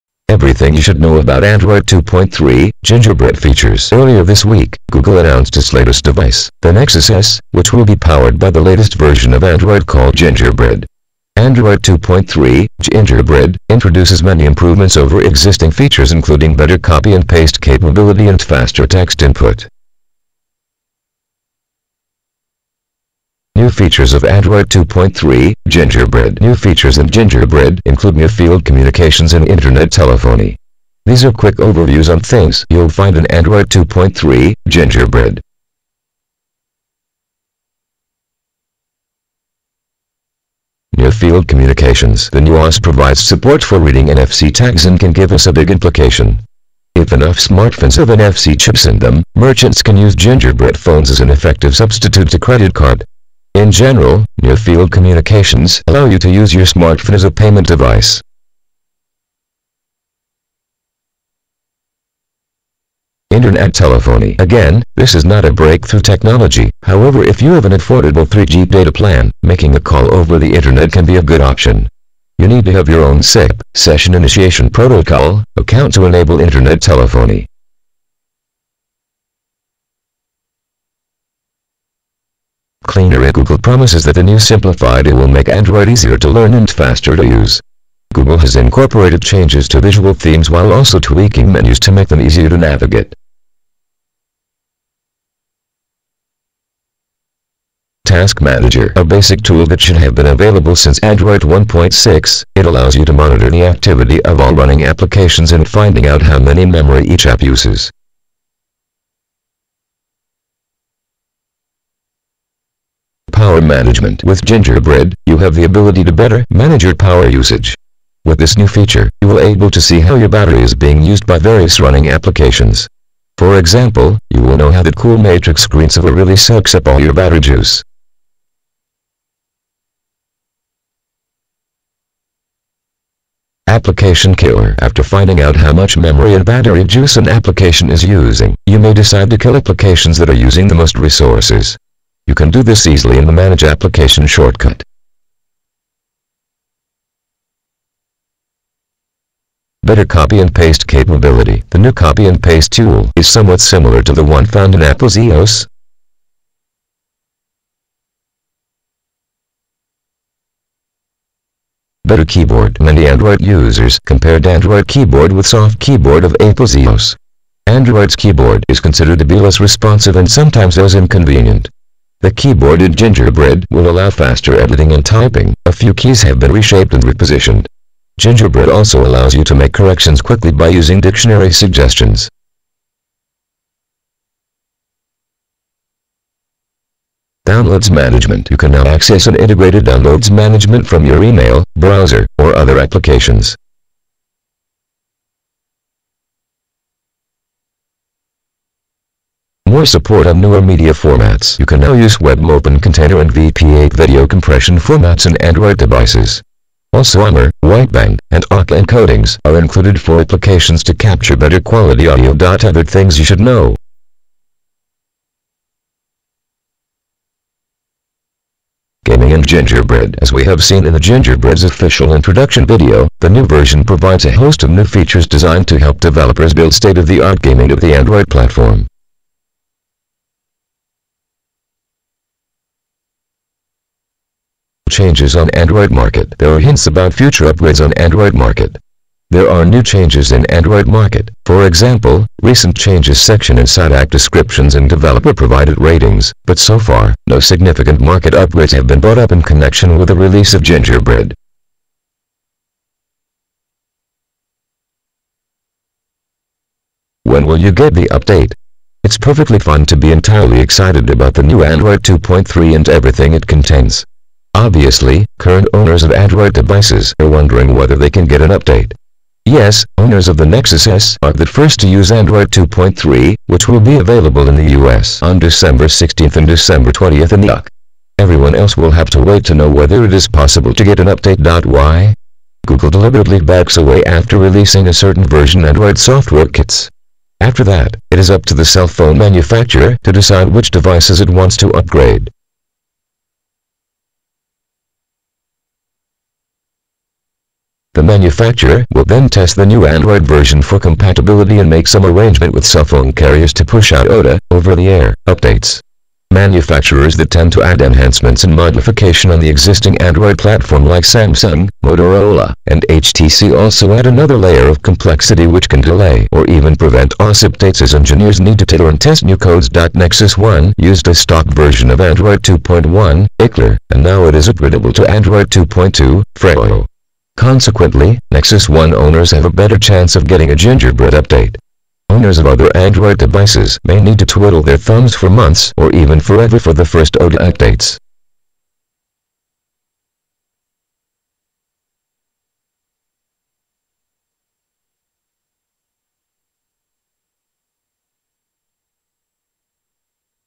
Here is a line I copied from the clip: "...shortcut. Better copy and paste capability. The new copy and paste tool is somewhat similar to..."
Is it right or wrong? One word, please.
right.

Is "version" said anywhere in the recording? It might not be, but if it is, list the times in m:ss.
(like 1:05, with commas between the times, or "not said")
0:08, 3:43, 4:45, 5:00, 5:21.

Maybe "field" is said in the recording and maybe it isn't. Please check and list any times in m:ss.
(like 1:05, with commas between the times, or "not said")
0:28, 0:41, 0:54.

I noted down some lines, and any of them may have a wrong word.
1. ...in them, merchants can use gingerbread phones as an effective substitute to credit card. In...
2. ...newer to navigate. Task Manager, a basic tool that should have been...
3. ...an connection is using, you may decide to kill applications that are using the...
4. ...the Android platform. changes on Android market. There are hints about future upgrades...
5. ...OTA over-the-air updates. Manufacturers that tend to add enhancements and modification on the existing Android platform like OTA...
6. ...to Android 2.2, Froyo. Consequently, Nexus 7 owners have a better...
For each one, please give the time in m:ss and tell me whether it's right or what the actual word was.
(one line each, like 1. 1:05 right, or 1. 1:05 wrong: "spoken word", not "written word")
1. 0:48 right
2. 1:32 wrong: "easier", not "newer"
3. 2:17 wrong: "application", not "connection"
4. 3:47 right
5. 5:04 wrong: "Samsung", not "OTA"
6. 5:24 wrong: "1", not "7".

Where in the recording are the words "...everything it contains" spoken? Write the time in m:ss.
4:22.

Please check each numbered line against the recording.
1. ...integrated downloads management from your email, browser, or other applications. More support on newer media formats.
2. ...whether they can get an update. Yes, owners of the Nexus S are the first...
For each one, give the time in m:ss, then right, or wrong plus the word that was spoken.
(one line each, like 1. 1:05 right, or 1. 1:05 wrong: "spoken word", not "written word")
1. 3:09 right
2. 4:27 right.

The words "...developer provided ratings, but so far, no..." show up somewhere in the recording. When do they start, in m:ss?
4:04.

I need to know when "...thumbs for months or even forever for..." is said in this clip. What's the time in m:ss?
5:34.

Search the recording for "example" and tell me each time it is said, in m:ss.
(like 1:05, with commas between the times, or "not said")
2:03, 4:01.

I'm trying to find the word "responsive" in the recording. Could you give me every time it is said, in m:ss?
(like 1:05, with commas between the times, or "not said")
2:49.